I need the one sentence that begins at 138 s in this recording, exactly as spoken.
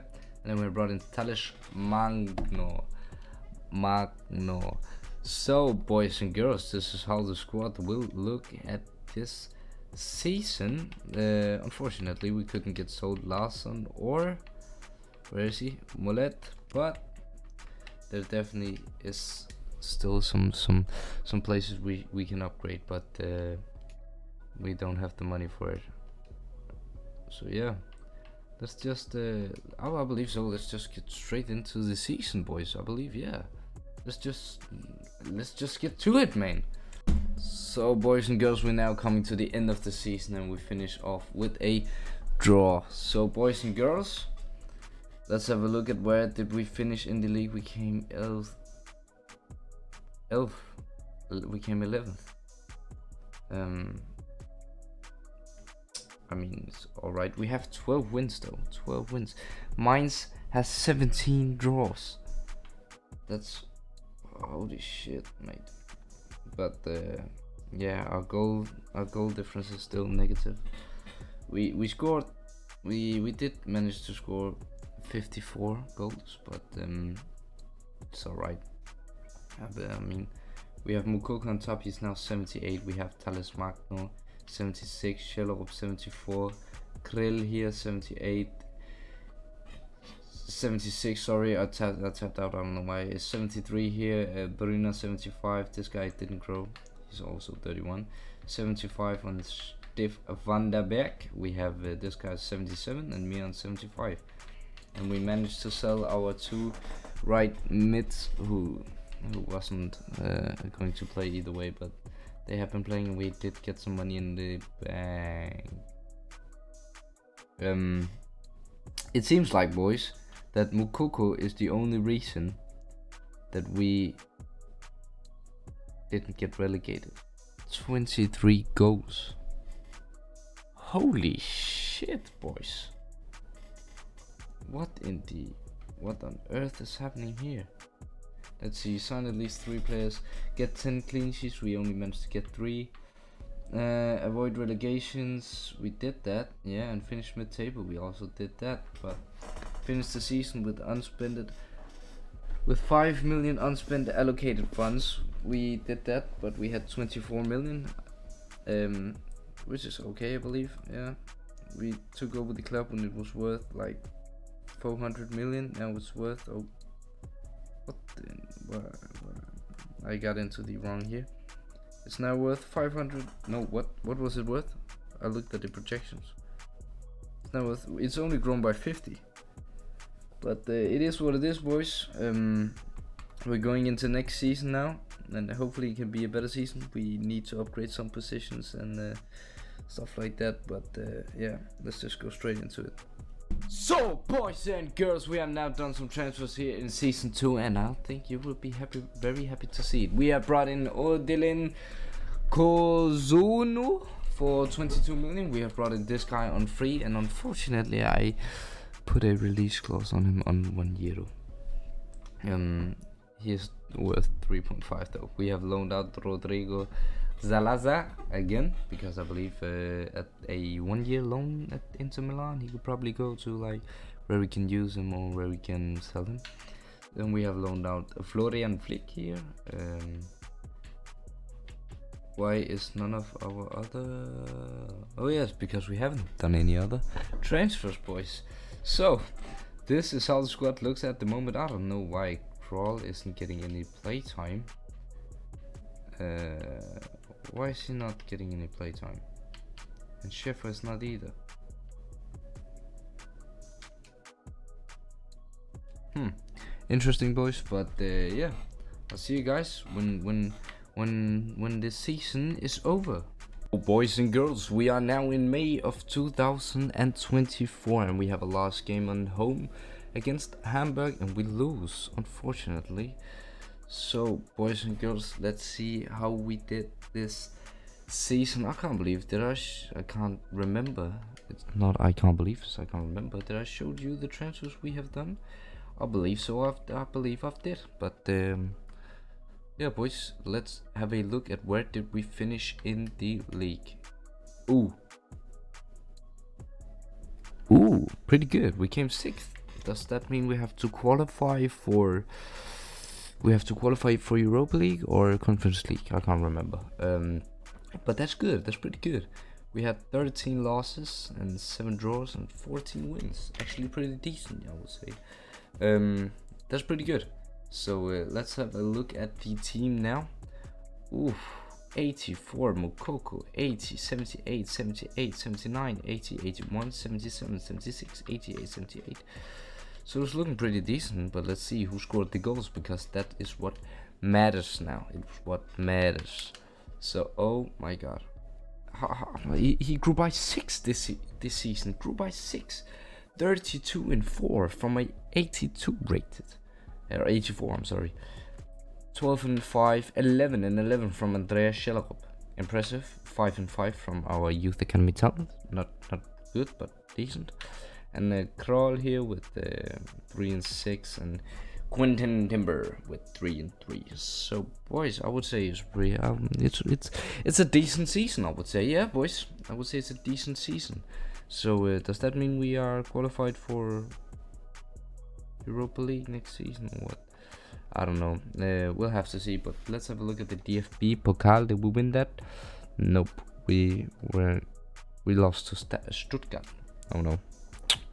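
Let's see, sign at least three players.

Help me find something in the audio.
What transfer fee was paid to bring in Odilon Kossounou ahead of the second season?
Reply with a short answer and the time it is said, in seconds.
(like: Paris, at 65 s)
22 million, at 204 s.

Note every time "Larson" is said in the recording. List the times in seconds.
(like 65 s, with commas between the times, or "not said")
13 s.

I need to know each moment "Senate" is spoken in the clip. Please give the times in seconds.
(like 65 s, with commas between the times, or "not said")
not said.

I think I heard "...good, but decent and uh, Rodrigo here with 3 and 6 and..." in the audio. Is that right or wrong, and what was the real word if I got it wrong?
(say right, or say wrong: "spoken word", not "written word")
wrong: "Kral", not "Rodrigo".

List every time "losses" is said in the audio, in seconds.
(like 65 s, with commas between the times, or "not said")
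310 s.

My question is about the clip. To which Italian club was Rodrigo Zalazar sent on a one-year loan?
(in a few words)
Inter Milan.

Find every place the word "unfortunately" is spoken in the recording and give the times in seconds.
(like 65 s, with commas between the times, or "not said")
11 s, 207 s, 272 s.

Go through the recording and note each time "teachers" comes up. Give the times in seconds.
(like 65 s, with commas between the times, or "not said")
not said.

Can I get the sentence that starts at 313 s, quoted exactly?
Actually, pretty decent, I would say.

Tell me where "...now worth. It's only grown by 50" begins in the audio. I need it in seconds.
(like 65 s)
177 s.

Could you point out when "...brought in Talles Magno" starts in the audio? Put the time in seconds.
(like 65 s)
0 s.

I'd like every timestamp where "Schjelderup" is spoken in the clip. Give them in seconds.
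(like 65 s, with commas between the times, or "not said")
85 s, 351 s.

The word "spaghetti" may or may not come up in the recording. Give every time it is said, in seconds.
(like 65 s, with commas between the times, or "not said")
not said.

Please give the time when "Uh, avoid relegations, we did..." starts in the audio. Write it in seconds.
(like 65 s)
143 s.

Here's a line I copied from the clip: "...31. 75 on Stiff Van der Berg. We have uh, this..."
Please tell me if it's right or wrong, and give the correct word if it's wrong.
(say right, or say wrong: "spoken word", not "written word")
right.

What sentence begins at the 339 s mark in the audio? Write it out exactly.
He, he grew by 6 this, this season.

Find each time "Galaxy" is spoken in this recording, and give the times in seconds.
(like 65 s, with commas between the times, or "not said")
not said.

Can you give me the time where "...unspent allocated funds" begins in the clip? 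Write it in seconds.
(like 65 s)
153 s.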